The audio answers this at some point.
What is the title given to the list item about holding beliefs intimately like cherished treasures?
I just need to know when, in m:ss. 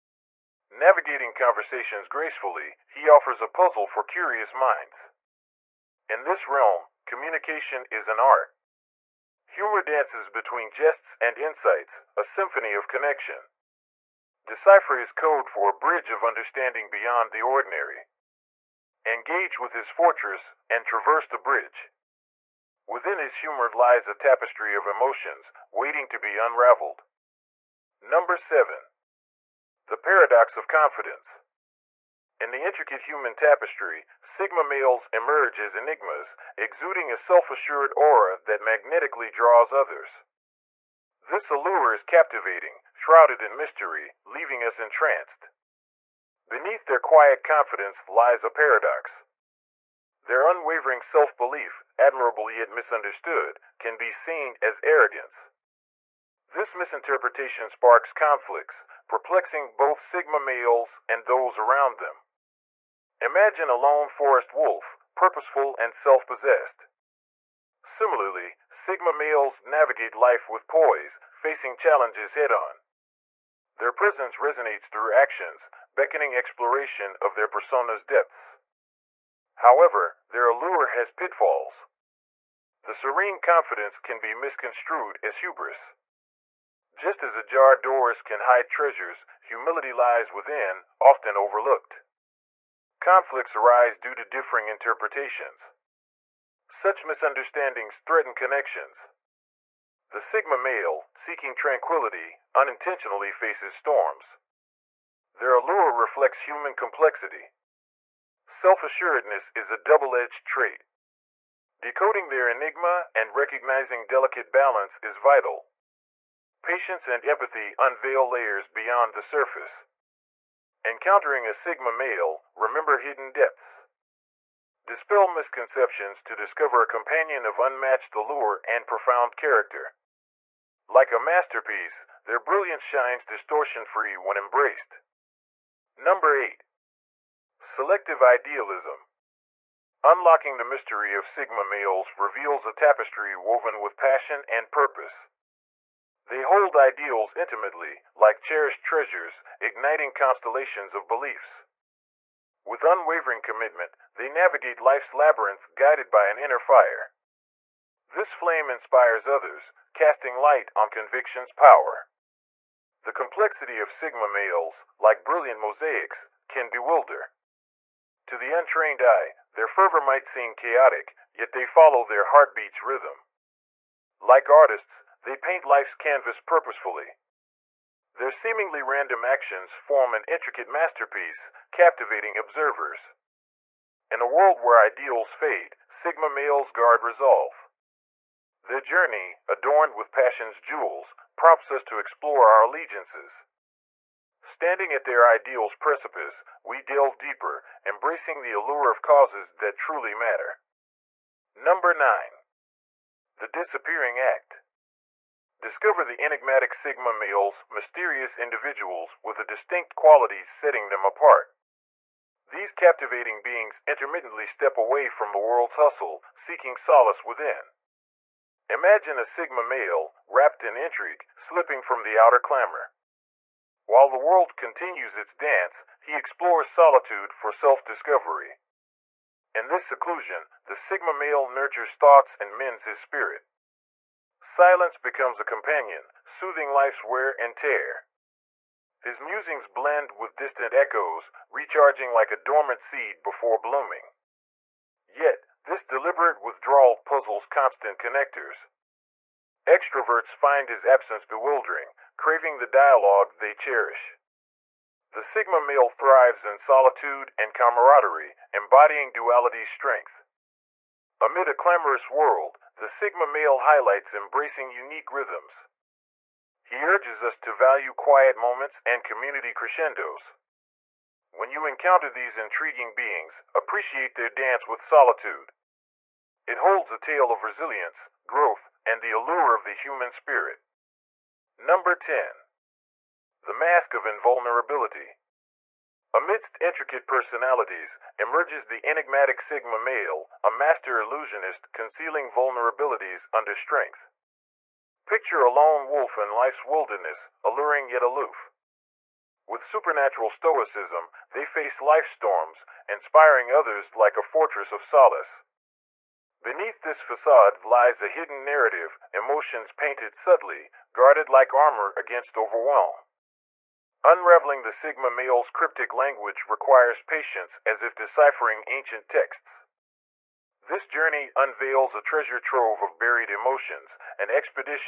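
2:17.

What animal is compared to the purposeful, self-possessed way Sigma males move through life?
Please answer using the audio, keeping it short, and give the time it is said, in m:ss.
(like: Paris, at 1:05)
Lone forest wolf, at 1:03.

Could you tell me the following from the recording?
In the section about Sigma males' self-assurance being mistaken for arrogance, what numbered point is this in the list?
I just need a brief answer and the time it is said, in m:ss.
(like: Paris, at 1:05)
7, at 0:27.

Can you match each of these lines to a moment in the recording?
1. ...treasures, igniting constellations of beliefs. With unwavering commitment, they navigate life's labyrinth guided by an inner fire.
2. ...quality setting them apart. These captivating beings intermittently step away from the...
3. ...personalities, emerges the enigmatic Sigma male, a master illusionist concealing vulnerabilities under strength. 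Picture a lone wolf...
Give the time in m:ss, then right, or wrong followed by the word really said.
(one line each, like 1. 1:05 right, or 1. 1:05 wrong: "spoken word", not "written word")
1. 2:28 right
2. 3:29 right
3. 4:47 right.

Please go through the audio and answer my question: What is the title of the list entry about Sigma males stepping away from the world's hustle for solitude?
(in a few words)
The Disappearing Act.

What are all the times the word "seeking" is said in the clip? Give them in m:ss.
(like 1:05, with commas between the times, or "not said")
1:41, 3:36.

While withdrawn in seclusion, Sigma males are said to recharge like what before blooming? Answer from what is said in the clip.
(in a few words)
Dormant seed.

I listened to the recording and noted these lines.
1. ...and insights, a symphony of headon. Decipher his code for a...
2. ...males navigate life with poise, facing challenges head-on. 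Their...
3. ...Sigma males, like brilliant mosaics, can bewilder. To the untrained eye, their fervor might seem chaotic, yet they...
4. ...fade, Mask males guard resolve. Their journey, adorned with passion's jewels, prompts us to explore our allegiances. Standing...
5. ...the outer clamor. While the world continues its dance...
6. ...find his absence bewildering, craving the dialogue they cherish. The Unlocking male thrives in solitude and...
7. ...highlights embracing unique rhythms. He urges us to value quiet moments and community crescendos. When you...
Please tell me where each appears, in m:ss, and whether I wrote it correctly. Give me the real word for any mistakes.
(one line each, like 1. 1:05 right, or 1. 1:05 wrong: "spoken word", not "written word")
1. 0:11 wrong: "connection", not "headon"
2. 1:09 right
3. 2:43 right
4. 3:05 wrong: "Sigma", not "Mask"
5. 3:42 right
6. 4:10 wrong: "Sigma", not "Unlocking"
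7. 4:23 right.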